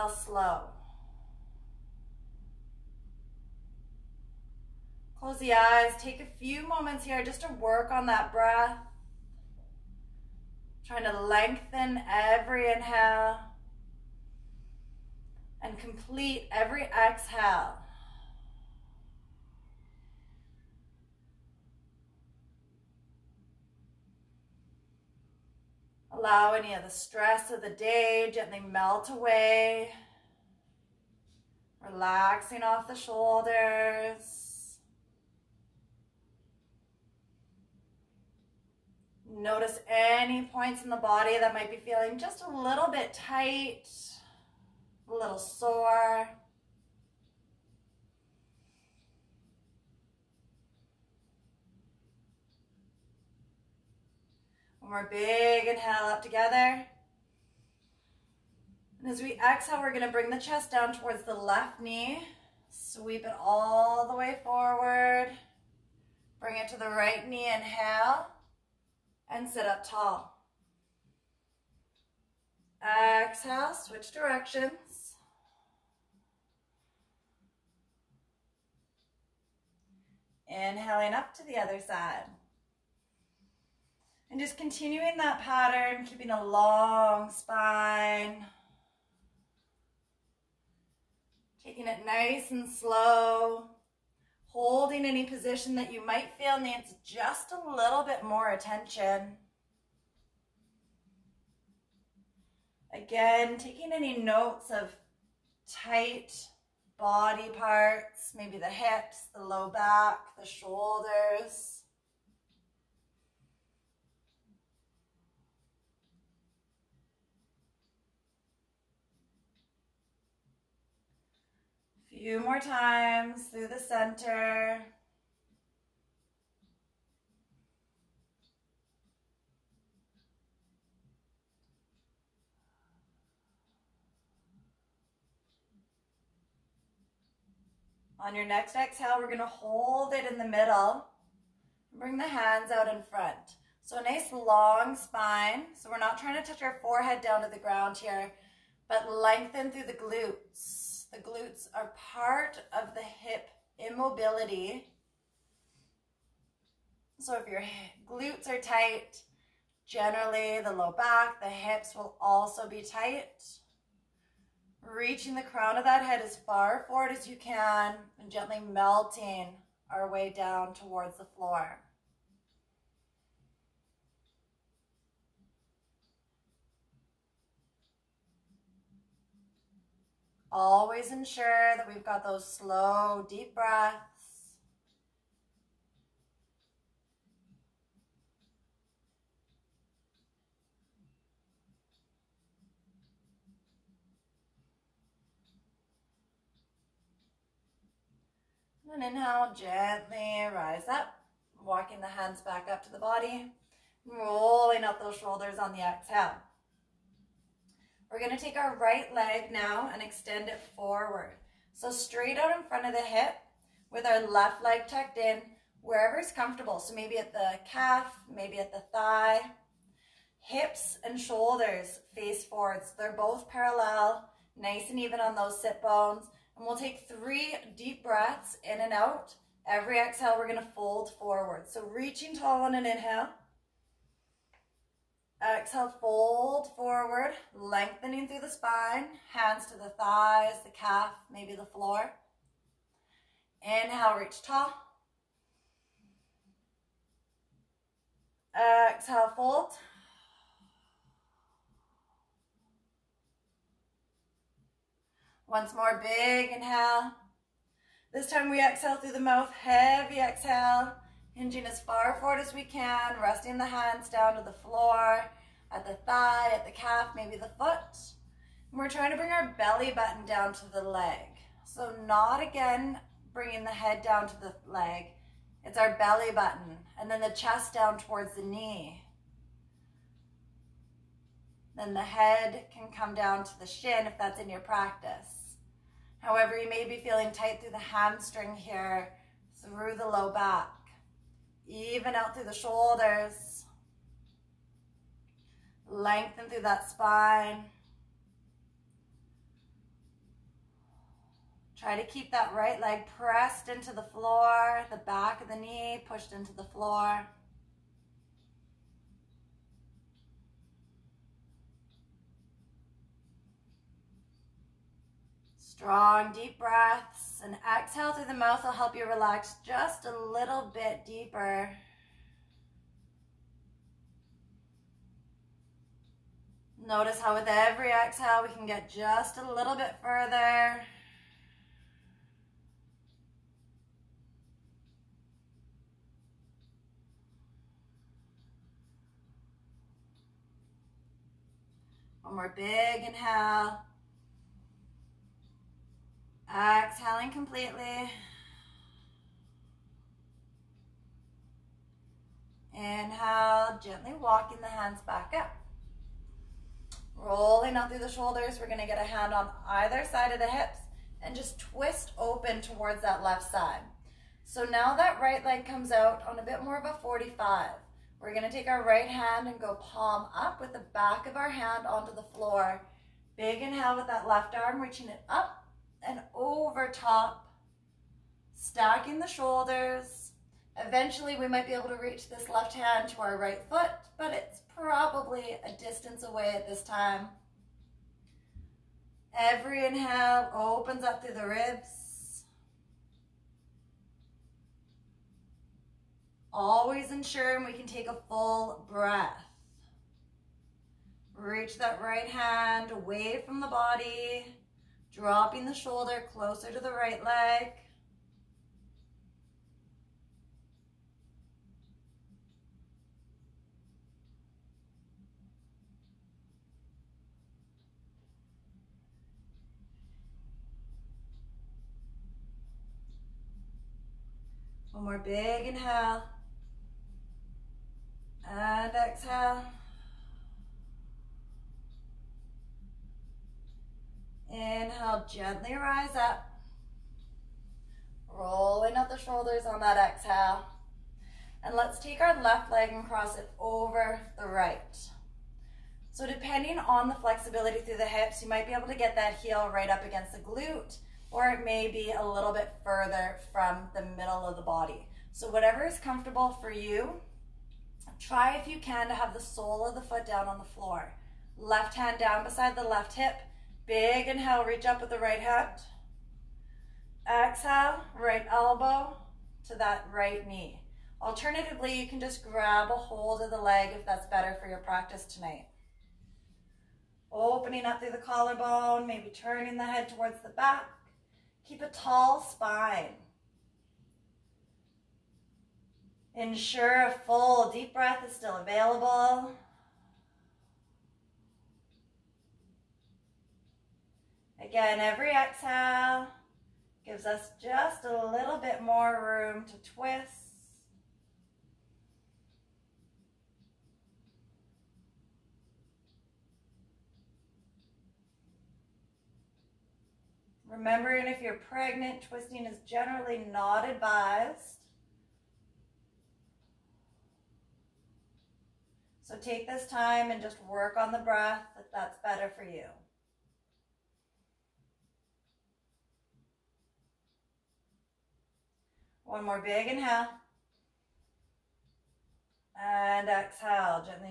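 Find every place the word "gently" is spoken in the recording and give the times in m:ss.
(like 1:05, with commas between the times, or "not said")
0:28, 2:48, 3:19, 5:53, 7:15.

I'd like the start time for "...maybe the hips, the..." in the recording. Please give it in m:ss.
1:48.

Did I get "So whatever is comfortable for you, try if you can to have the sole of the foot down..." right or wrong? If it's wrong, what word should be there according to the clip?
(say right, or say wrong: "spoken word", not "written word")
right.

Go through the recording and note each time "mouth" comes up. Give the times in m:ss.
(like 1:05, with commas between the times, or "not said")
4:19, 5:18.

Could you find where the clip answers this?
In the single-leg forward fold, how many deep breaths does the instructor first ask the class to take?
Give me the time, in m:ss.
3:47.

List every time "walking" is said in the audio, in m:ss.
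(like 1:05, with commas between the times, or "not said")
3:21, 5:54.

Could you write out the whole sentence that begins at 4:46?
However, you may be feeling tight through the hamstring here, through the low back.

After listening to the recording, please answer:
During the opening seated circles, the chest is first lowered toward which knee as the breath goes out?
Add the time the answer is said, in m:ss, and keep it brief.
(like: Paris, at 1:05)
Left knee, at 1:01.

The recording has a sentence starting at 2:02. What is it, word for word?
few more times through the center.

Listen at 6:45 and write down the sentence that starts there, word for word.
Dropping the shoulder closer to the right leg.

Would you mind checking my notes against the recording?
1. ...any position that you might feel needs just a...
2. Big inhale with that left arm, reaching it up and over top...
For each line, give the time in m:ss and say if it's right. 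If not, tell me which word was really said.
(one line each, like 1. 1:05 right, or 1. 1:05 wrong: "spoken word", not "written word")
1. 1:35 right
2. 6:13 right.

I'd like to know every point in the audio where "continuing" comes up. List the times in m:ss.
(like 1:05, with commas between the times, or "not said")
1:24.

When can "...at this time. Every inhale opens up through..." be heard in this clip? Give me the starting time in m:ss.
6:26.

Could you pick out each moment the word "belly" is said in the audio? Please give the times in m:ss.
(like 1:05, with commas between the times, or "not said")
4:29, 4:35.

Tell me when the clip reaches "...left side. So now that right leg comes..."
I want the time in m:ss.
6:03.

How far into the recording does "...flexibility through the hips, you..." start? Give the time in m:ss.
7:27.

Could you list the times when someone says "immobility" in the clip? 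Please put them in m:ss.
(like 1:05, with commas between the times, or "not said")
2:33.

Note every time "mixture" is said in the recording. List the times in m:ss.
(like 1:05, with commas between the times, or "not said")
not said.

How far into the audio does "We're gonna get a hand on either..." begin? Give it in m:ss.
5:58.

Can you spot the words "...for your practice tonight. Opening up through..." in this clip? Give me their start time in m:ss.
7:54.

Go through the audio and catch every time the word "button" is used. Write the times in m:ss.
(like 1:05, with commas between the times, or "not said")
4:29, 4:36.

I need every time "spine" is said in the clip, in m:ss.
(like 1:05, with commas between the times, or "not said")
1:27, 2:24, 3:58, 4:56, 8:02.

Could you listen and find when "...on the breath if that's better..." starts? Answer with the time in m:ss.
8:40.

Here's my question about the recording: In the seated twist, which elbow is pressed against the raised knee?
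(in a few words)
Right elbow.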